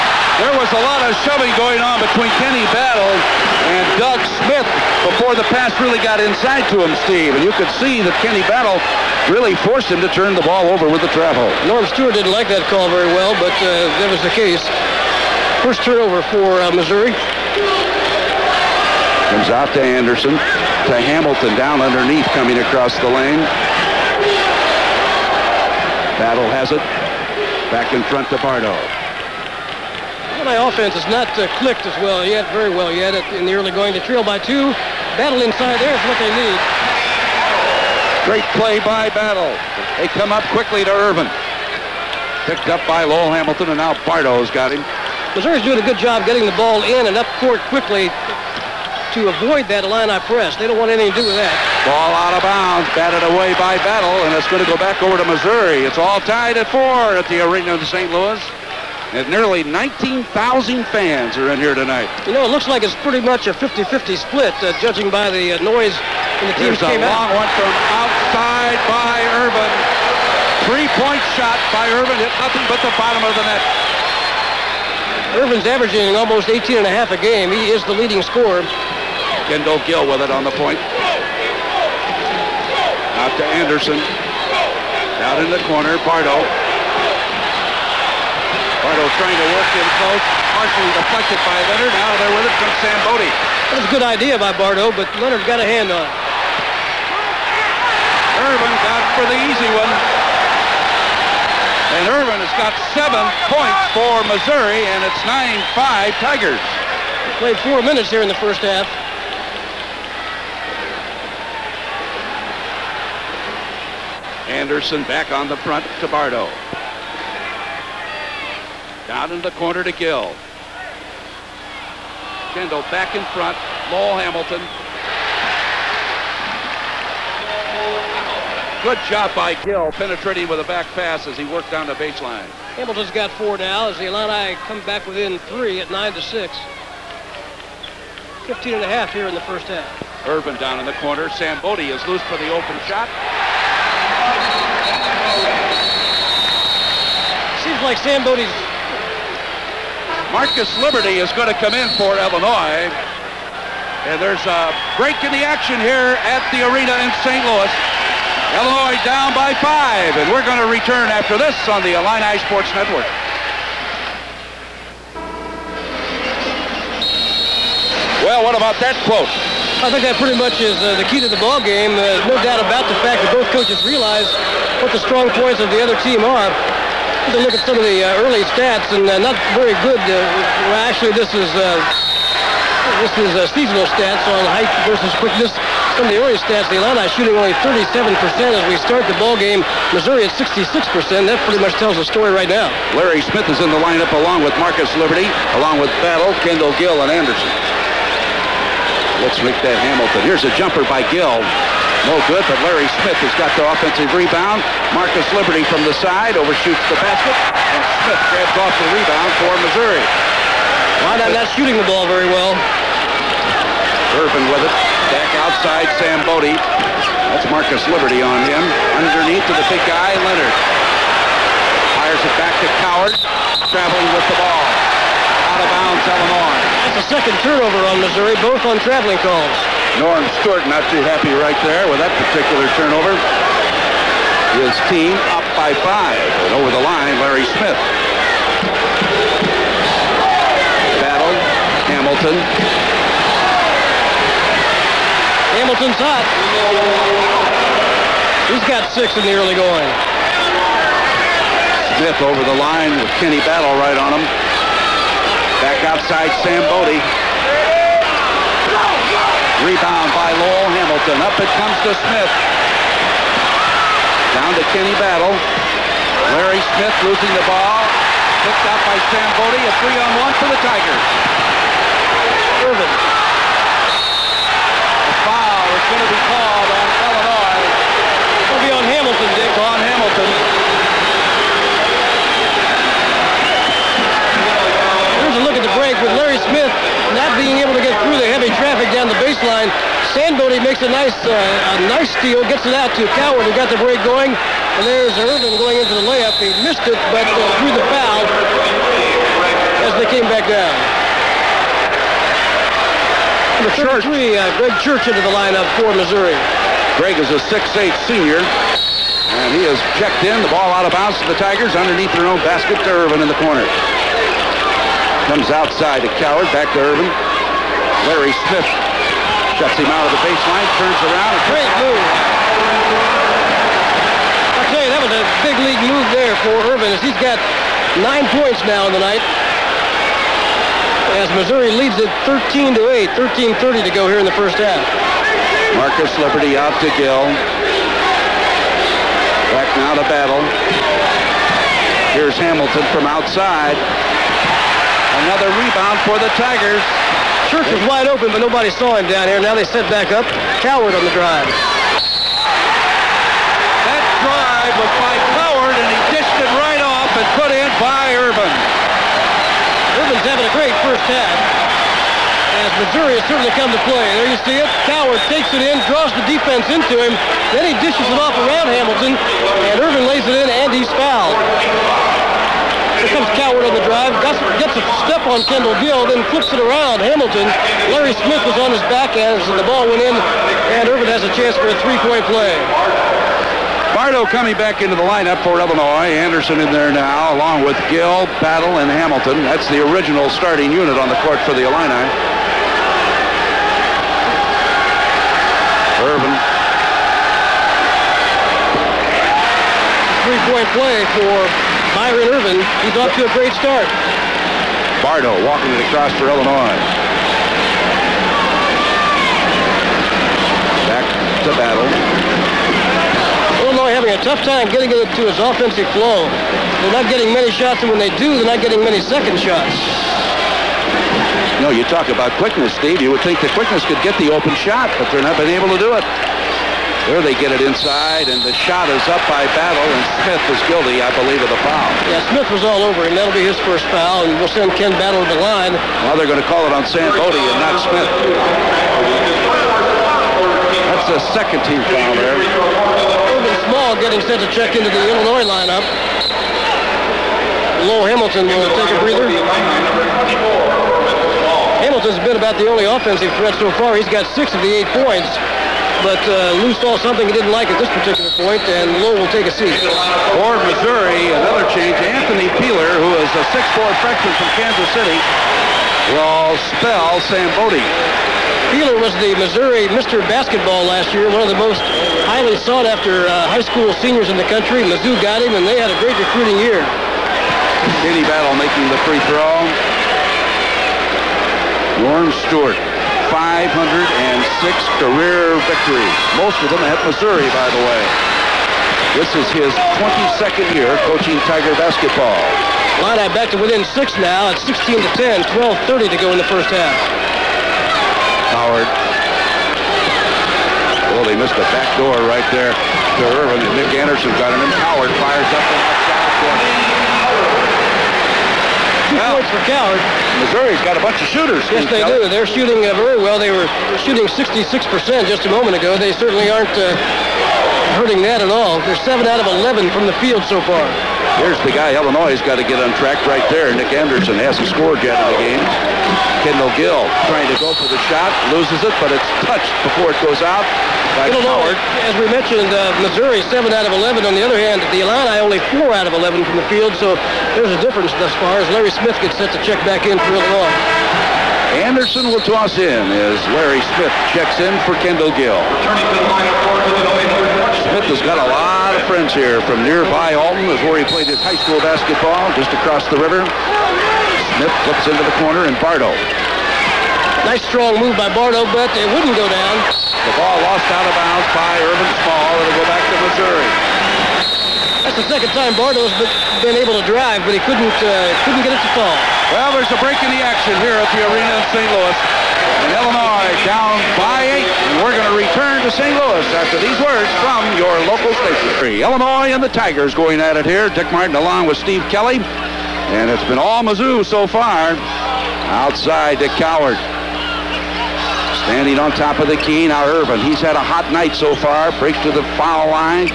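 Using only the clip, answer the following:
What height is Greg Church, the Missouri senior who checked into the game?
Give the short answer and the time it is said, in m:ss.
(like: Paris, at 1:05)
6'8, at 5:07.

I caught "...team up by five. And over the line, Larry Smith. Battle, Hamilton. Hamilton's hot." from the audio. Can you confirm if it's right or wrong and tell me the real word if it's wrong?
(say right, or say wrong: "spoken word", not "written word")
right.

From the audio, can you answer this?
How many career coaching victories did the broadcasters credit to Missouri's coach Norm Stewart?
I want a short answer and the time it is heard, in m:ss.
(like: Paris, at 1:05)
506, at 8:03.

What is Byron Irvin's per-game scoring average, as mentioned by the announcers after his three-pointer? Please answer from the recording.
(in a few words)
18.5.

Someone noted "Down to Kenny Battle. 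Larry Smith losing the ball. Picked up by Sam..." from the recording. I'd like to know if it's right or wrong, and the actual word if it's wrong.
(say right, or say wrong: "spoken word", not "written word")
right.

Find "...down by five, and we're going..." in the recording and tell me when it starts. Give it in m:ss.
2:39.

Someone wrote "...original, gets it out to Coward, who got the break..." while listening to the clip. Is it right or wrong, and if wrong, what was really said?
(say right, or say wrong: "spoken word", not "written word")
wrong: "steal", not "original".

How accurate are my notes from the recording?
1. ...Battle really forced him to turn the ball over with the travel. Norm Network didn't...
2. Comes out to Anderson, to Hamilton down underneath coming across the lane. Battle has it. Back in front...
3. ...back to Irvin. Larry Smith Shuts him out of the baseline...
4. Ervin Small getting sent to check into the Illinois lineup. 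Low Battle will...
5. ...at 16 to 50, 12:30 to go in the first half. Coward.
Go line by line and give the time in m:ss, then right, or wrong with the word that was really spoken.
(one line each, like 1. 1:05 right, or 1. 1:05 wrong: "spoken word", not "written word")
1. 0:08 wrong: "Stewart", not "Network"
2. 0:19 right
3. 5:16 right
4. 7:22 wrong: "Hamilton", not "Battle"
5. 8:14 wrong: "10", not "50".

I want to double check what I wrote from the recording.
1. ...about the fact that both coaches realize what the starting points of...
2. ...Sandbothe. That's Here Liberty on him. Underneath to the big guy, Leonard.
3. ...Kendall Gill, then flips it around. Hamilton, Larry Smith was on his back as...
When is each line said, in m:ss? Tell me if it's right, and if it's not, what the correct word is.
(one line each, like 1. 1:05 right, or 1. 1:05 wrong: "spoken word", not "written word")
1. 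2:52 wrong: "strong", not "starting"
2. 3:35 wrong: "Marcus", not "Here"
3. 6:15 right.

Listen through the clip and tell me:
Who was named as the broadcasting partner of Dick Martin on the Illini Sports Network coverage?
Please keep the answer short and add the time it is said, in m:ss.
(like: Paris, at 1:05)
Steve Kelly, at 9:41.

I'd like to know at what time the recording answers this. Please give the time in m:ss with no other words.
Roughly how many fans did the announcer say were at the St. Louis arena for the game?
0:59.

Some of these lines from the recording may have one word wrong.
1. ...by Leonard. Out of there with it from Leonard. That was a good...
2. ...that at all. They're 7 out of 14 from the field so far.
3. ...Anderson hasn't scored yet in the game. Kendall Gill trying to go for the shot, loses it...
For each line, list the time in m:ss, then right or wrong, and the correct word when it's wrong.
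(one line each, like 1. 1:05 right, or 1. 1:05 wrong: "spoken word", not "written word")
1. 1:31 wrong: "Sandbothe", not "Leonard"
2. 8:38 wrong: "11", not "14"
3. 8:43 right.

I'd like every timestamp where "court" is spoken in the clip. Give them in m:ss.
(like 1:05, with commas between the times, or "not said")
0:47, 6:31.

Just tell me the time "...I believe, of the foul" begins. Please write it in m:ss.
7:11.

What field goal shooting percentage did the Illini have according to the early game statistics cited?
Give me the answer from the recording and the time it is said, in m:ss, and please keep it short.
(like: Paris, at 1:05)
37%, at 3:07.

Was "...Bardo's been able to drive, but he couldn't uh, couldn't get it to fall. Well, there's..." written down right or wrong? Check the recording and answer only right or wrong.
right.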